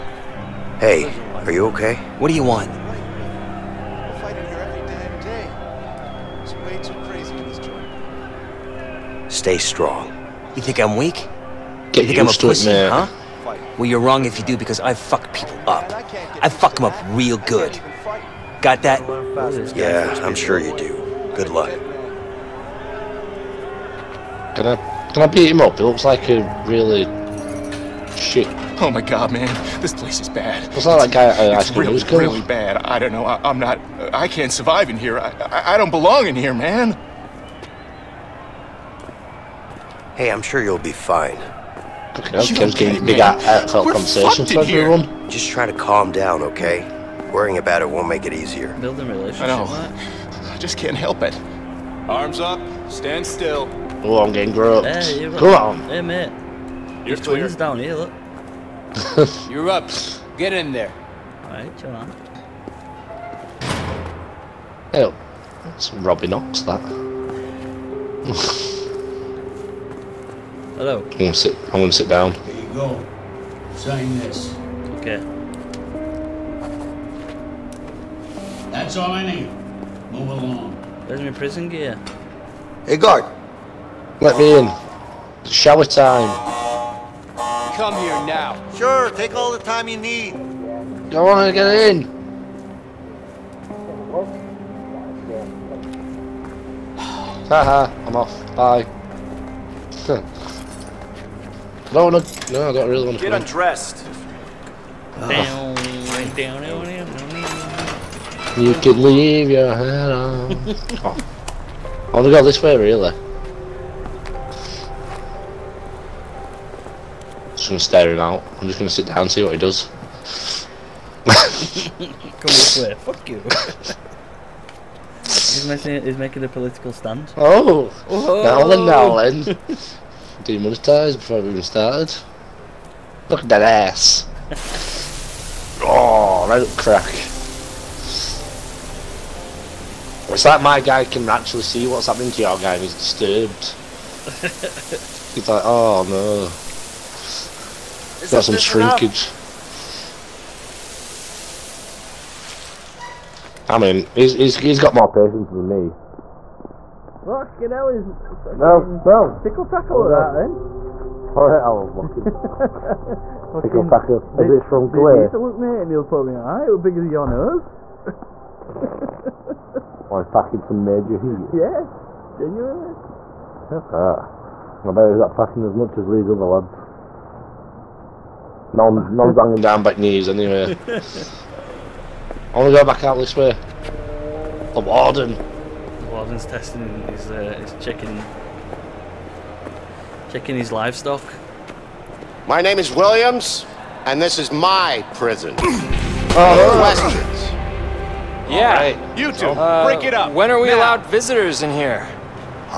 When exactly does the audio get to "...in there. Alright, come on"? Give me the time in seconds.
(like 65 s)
60 s.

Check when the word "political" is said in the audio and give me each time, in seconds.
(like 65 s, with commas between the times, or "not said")
126 s.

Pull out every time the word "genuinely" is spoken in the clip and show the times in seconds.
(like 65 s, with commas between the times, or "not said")
172 s.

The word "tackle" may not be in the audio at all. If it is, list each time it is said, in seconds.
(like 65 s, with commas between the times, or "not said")
159 s, 163 s.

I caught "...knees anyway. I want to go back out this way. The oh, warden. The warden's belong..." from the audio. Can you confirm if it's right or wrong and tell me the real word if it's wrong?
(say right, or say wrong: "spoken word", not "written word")
wrong: "testing", not "belong".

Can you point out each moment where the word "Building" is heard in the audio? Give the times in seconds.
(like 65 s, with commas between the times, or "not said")
48 s.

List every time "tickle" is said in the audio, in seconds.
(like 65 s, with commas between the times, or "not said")
159 s, 163 s.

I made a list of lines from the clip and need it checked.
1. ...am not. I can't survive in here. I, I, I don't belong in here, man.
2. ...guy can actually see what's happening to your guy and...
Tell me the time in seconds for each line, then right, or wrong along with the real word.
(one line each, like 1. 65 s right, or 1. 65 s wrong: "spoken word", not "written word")
1. 33 s right
2. 140 s right.